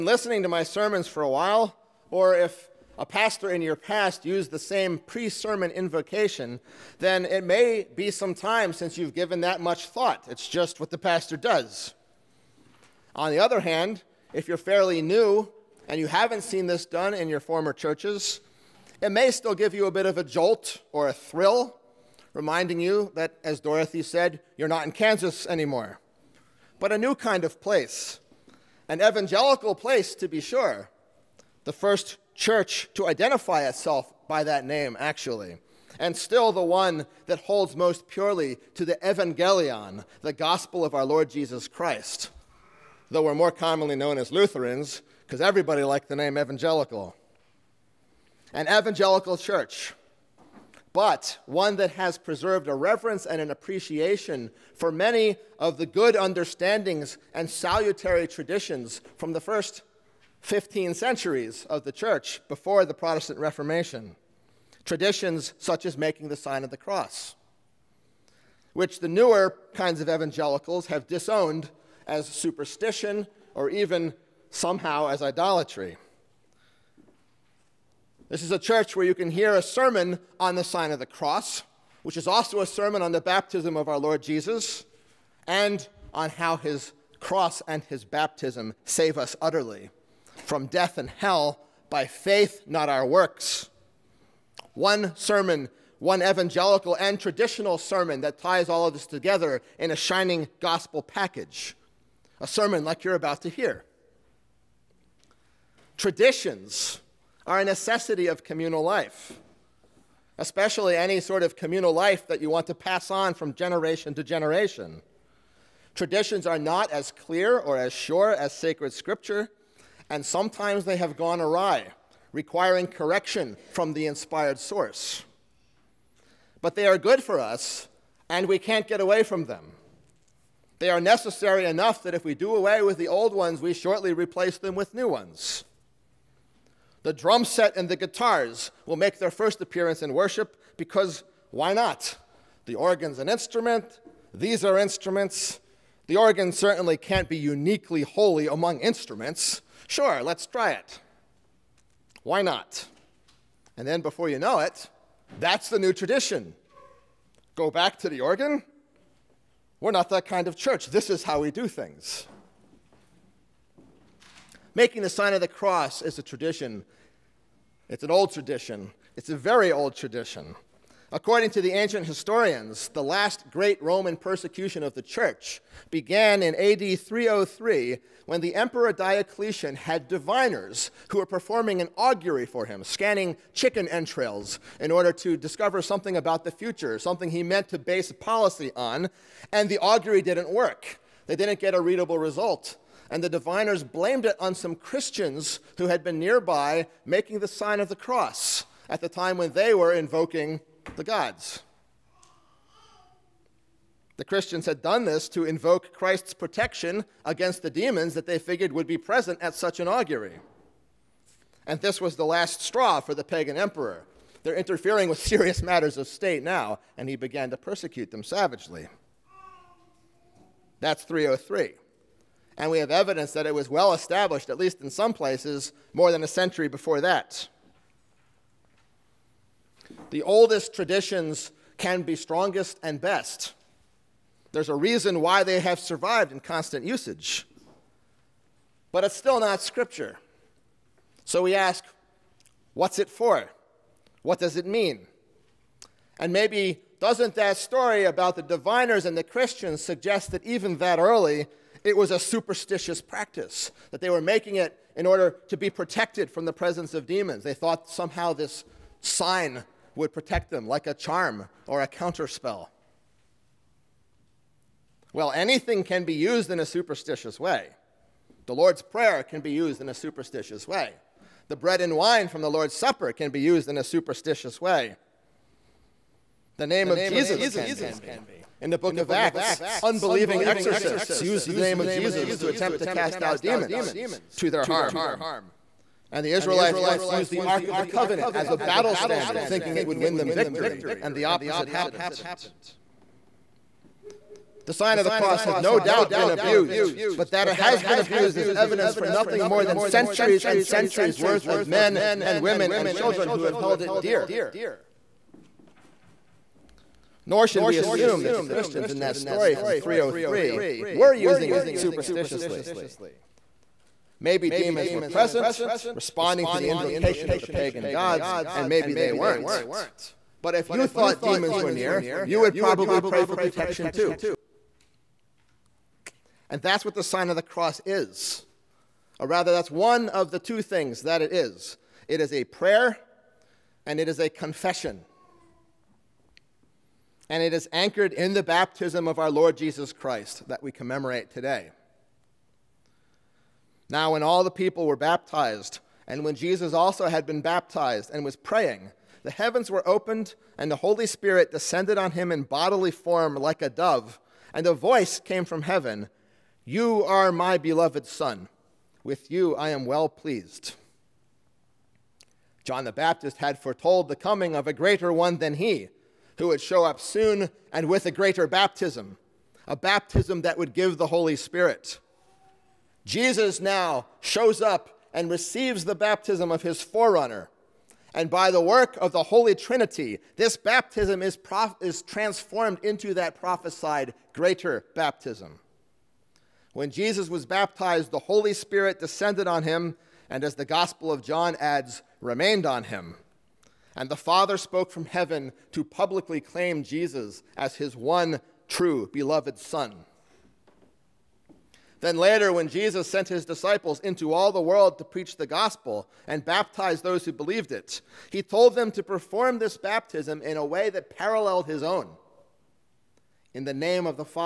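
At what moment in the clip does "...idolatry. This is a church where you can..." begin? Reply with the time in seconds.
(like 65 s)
75 s.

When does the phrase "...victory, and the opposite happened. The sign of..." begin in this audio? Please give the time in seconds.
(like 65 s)
290 s.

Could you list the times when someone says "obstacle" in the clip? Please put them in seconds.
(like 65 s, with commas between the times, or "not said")
not said.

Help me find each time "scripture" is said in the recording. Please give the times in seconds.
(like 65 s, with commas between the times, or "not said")
118 s, 239 s.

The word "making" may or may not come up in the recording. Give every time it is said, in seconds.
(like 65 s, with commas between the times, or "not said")
65 s, 164 s, 197 s, 254 s.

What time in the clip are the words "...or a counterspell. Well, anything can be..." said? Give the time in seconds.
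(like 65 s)
261 s.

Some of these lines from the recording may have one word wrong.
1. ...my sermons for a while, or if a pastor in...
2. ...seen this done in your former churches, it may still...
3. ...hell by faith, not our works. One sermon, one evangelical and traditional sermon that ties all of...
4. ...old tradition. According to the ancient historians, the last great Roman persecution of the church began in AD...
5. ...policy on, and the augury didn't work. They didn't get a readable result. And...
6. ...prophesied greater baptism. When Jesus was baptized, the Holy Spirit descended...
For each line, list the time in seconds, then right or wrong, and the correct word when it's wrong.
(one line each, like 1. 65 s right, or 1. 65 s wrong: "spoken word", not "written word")
1. 0 s right
2. 16 s right
3. 91 s right
4. 169 s right
5. 188 s right
6. 383 s right.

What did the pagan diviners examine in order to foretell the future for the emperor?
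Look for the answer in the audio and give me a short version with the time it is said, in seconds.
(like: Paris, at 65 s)
Chicken entrails, at 183 s.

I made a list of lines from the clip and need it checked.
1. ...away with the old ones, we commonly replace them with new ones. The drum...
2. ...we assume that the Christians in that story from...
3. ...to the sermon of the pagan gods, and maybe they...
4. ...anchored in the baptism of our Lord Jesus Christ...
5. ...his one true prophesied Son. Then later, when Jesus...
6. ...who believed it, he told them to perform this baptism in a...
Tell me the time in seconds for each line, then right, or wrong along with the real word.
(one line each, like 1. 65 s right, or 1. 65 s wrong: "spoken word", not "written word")
1. 132 s wrong: "shortly", not "commonly"
2. 307 s right
3. 316 s wrong: "invocation", not "sermon"
4. 337 s right
5. 397 s wrong: "beloved", not "prophesied"
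6. 407 s right.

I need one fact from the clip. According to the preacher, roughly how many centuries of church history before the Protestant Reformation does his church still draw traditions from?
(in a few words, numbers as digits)
15.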